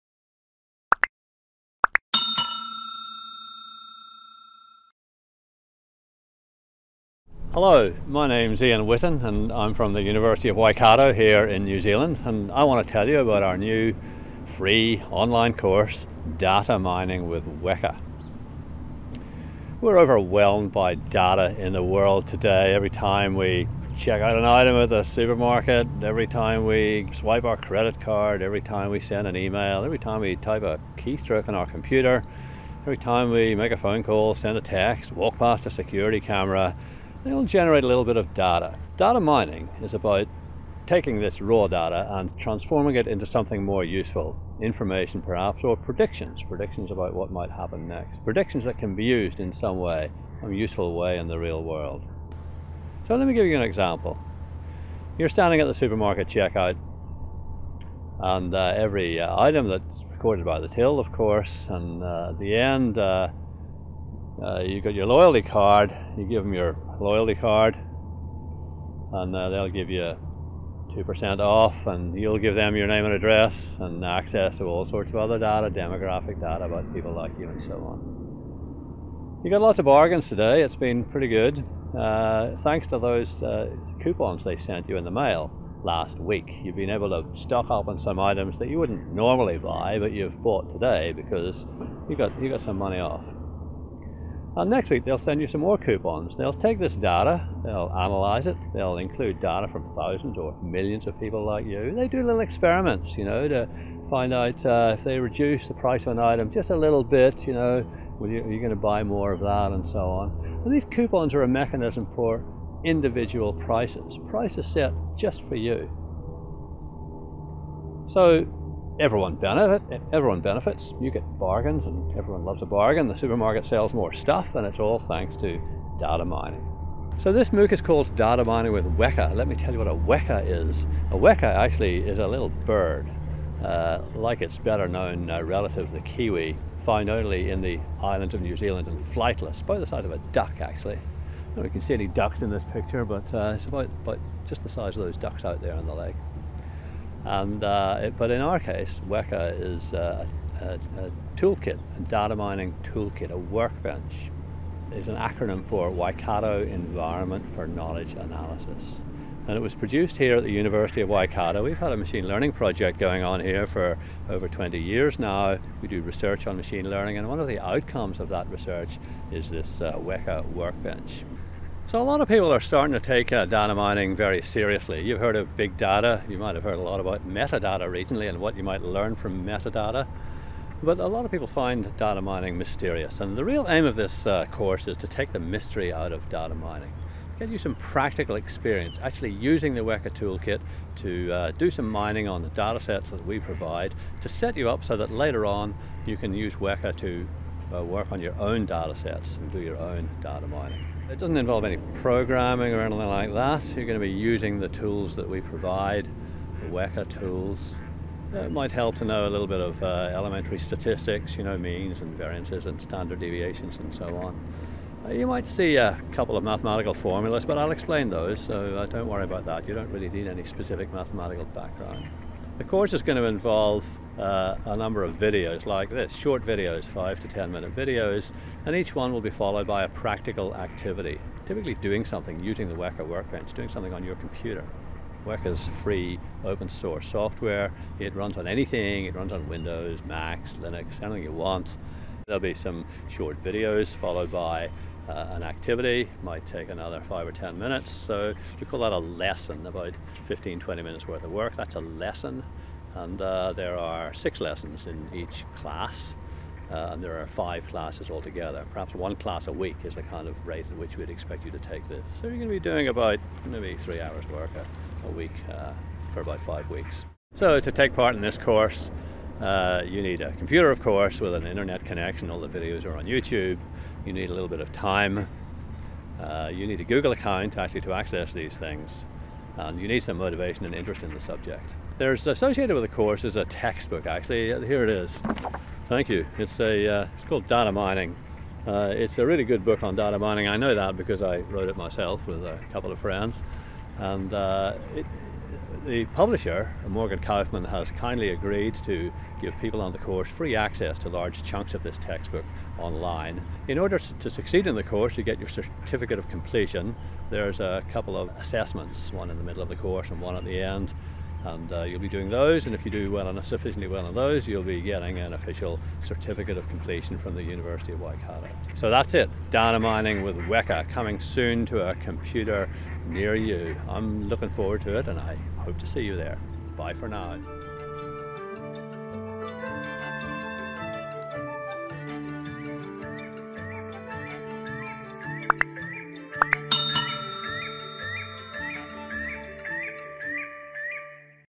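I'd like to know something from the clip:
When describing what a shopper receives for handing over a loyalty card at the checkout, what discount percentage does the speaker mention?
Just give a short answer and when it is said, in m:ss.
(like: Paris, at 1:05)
2%, at 1:10.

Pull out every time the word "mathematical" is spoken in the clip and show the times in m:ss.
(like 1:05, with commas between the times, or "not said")
3:36, 3:40.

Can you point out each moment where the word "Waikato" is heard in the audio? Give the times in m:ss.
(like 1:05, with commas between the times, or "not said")
0:10, 2:35, 2:41, 5:18.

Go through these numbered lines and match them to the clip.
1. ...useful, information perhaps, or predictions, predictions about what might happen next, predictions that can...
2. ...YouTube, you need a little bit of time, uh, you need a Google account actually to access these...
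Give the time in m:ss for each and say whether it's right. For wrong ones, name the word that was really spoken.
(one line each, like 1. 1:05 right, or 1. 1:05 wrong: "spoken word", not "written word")
1. 0:43 right
2. 4:33 right.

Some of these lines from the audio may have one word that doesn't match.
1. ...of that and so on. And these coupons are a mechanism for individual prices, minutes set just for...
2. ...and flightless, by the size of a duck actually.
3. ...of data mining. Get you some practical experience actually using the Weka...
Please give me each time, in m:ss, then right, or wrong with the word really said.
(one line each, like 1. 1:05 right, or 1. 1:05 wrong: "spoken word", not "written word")
1. 1:49 wrong: "prices", not "minutes"
2. 2:18 right
3. 3:06 right.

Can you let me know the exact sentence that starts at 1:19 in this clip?
You got lots of bargains today, it's been pretty good.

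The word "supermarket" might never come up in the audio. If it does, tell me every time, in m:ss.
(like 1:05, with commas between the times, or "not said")
0:25, 0:55, 2:03.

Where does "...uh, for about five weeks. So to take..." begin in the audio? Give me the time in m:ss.
4:25.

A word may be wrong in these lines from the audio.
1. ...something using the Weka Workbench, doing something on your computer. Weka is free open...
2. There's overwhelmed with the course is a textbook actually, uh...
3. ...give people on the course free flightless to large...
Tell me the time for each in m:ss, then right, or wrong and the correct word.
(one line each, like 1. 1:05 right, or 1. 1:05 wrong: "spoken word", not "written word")
1. 3:52 right
2. 4:41 wrong: "associated", not "overwhelmed"
3. 4:59 wrong: "access", not "flightless".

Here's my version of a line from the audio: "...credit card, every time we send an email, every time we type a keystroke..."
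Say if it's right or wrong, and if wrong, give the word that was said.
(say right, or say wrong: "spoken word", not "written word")
right.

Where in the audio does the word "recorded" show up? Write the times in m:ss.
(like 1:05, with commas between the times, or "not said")
1:00.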